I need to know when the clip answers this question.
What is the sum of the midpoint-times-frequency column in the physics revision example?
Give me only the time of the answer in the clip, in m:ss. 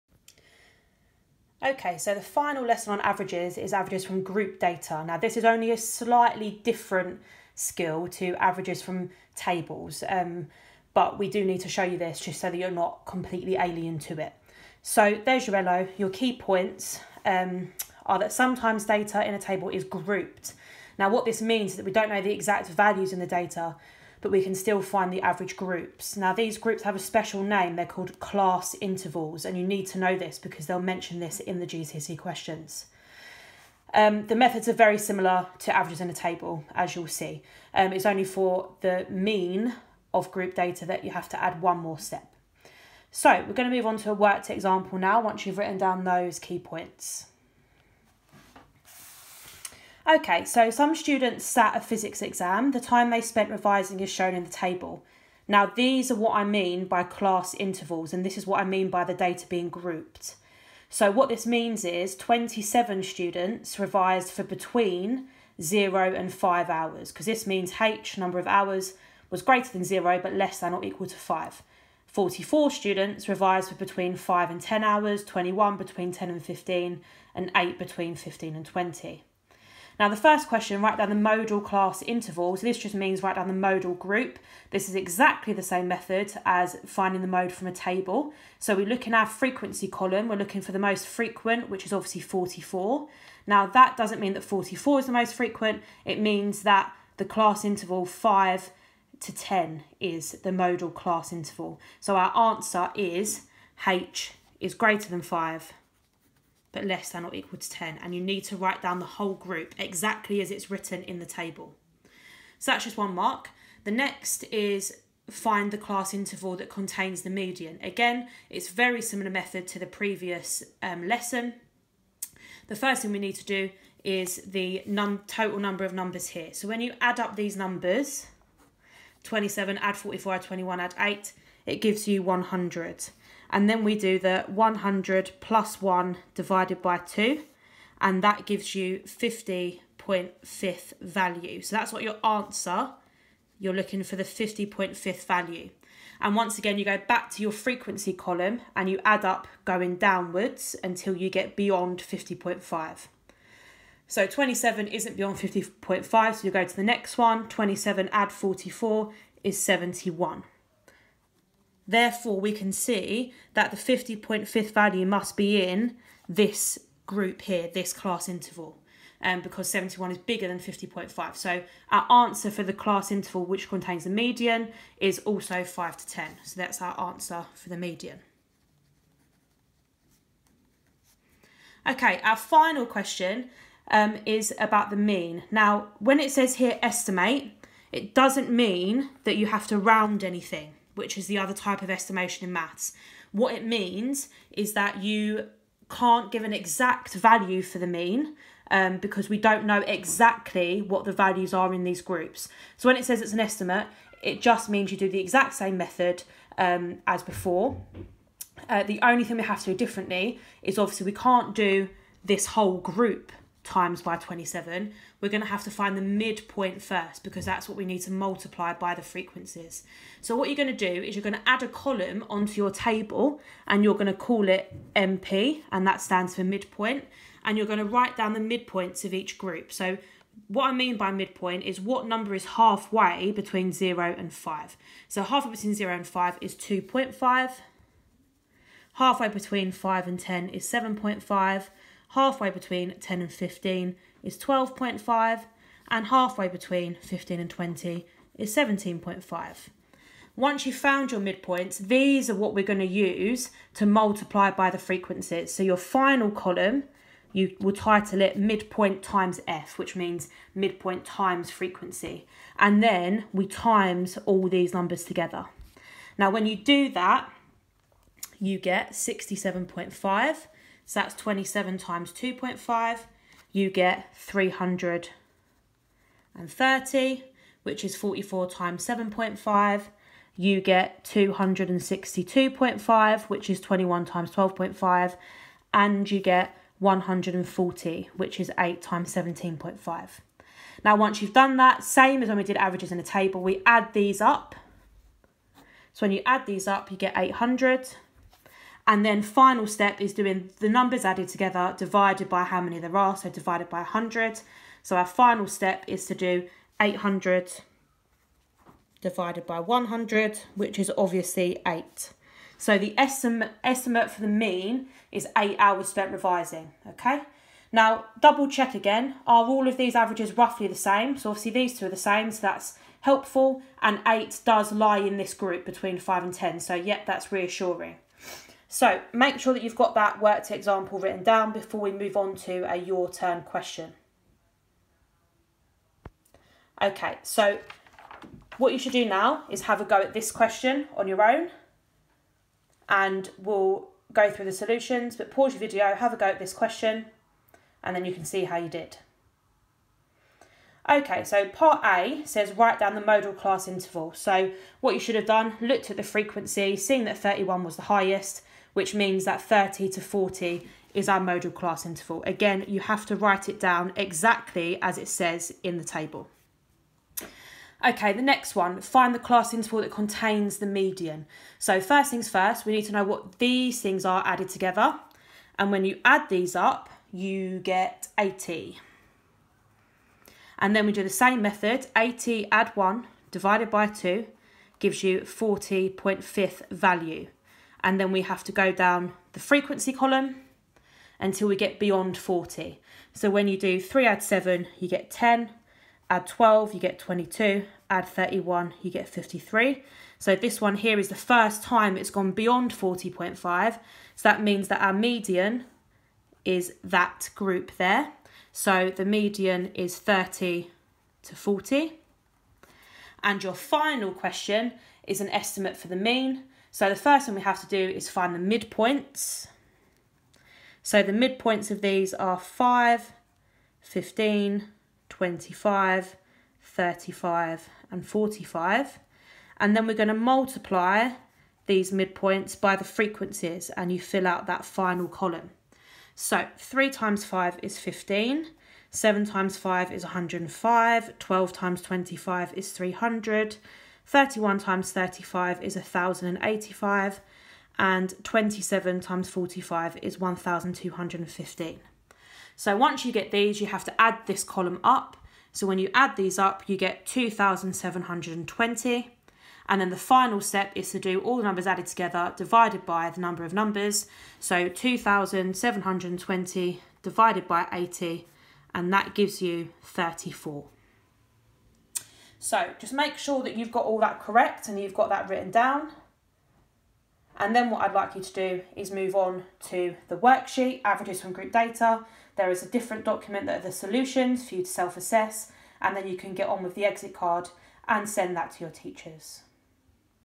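4:56.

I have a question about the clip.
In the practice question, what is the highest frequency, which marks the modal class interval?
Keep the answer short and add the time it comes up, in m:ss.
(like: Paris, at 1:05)
31, at 5:57.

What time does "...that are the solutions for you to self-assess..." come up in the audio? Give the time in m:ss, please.
8:03.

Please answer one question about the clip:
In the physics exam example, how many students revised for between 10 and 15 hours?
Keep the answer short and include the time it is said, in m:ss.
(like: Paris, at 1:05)
21, at 1:15.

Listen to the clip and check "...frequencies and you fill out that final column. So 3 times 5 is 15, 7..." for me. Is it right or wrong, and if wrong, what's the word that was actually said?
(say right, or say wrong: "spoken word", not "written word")
right.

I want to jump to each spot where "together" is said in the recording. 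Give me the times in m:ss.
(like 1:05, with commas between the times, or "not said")
4:25, 5:01, 6:14, 7:41.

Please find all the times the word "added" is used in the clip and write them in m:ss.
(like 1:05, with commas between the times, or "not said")
5:01, 6:14, 7:41.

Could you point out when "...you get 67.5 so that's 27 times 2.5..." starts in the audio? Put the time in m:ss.
4:28.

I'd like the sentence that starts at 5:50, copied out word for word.
Okay, so part A says write down the modal class interval.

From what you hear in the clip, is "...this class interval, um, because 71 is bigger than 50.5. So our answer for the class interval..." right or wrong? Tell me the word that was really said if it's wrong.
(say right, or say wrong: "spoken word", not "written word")
right.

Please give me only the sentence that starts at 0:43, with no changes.
So we're going to move on to a worked example now once you've written down those key points.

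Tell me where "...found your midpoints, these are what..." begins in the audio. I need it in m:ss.
4:10.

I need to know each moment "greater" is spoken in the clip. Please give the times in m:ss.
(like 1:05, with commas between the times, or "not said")
1:09, 1:44.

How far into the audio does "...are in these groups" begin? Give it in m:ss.
3:21.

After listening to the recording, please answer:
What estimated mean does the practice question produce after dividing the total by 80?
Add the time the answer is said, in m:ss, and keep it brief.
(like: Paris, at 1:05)
34, at 7:48.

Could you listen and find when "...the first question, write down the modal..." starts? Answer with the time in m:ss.
1:20.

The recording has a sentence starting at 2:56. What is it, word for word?
So that's our answer for the median.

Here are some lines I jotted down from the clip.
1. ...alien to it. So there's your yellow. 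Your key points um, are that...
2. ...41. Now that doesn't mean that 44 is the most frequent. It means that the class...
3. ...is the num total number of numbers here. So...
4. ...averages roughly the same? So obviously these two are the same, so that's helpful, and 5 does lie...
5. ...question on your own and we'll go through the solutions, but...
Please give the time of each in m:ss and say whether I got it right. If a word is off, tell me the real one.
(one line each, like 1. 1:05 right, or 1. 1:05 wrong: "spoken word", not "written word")
1. 0:13 right
2. 1:32 wrong: "44", not "41"
3. 2:04 right
4. 5:19 wrong: "8", not "5"
5. 5:40 right.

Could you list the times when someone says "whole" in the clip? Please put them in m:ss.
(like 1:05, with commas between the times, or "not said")
1:49, 3:32.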